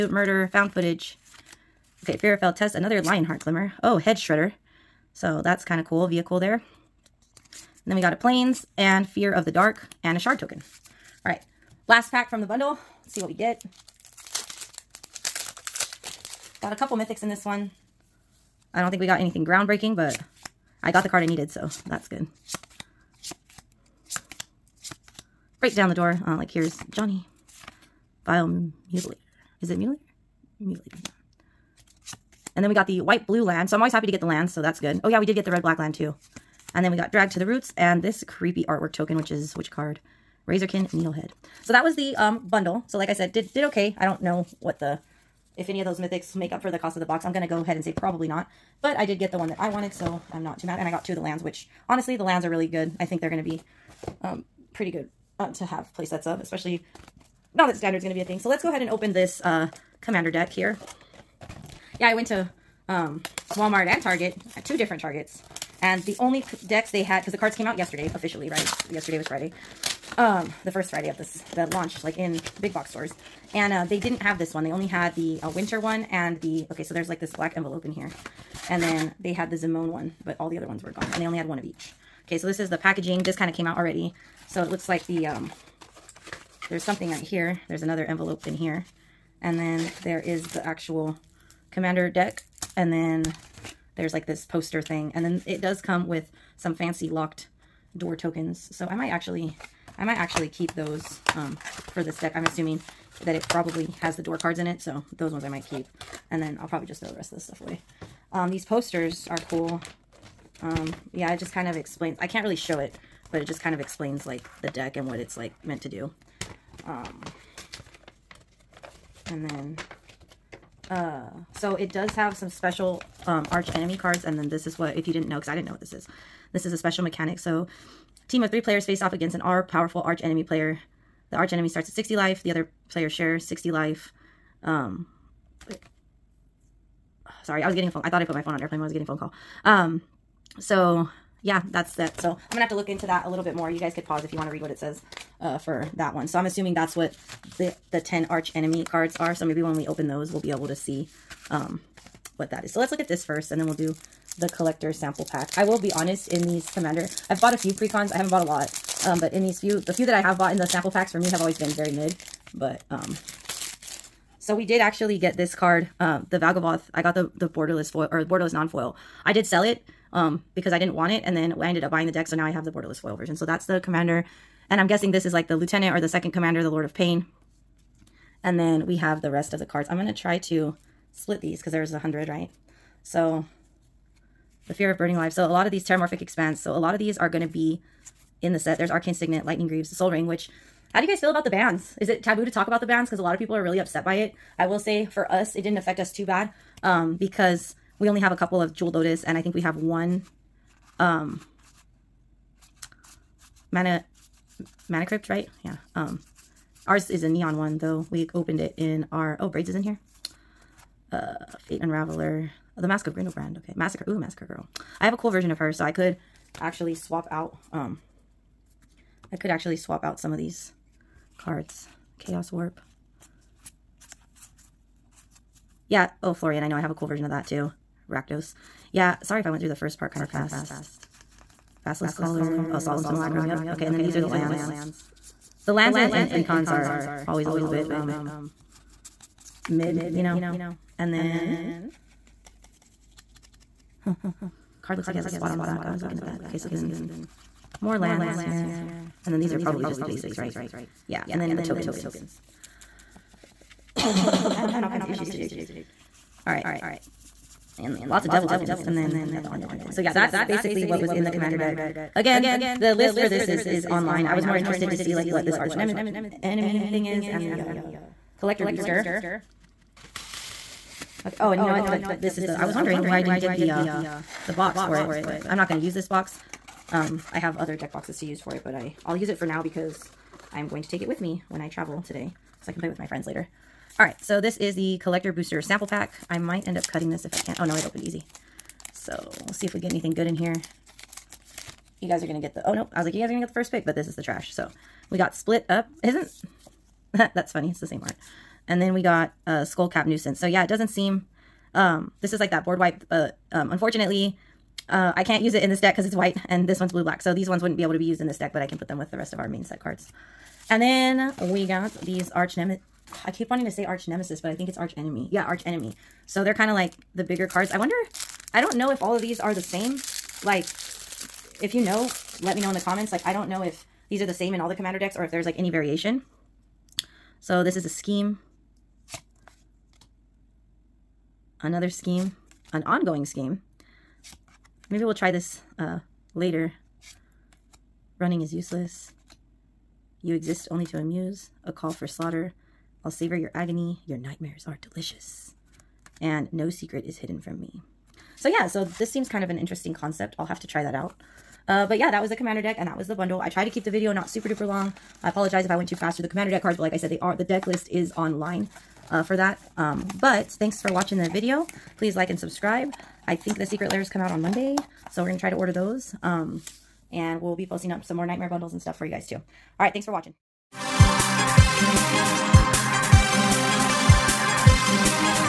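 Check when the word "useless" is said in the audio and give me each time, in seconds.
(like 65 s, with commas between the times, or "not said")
338 s.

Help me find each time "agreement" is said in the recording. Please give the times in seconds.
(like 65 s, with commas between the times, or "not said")
not said.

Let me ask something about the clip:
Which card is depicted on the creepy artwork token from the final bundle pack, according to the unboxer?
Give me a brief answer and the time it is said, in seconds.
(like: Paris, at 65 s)
Razorkin Needlehead, at 40 s.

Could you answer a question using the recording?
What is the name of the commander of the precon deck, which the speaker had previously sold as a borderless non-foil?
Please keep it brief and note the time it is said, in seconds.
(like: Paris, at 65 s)
Valgavoth, at 166 s.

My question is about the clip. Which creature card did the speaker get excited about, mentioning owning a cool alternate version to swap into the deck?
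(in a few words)
Massacre Girl.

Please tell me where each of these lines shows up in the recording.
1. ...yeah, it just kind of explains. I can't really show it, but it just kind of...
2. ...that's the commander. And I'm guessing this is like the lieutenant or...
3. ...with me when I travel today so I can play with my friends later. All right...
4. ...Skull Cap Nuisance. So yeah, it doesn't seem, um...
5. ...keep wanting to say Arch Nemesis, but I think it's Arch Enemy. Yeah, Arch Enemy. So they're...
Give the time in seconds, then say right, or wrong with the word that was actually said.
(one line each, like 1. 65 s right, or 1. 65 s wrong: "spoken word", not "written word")
1. 111 s right
2. 173 s right
3. 281 s right
4. 299 s right
5. 313 s right.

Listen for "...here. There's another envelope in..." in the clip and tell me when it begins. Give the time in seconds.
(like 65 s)
87 s.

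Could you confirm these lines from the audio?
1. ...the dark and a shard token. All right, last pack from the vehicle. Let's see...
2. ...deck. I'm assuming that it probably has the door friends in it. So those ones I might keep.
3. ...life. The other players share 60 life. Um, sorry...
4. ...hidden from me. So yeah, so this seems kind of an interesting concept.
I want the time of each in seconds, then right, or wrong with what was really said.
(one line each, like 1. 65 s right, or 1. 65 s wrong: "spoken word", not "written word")
1. 9 s wrong: "bundle", not "vehicle"
2. 102 s wrong: "cards", not "friends"
3. 132 s right
4. 347 s right.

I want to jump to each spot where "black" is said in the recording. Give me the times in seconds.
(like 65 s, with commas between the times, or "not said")
35 s, 77 s, 306 s.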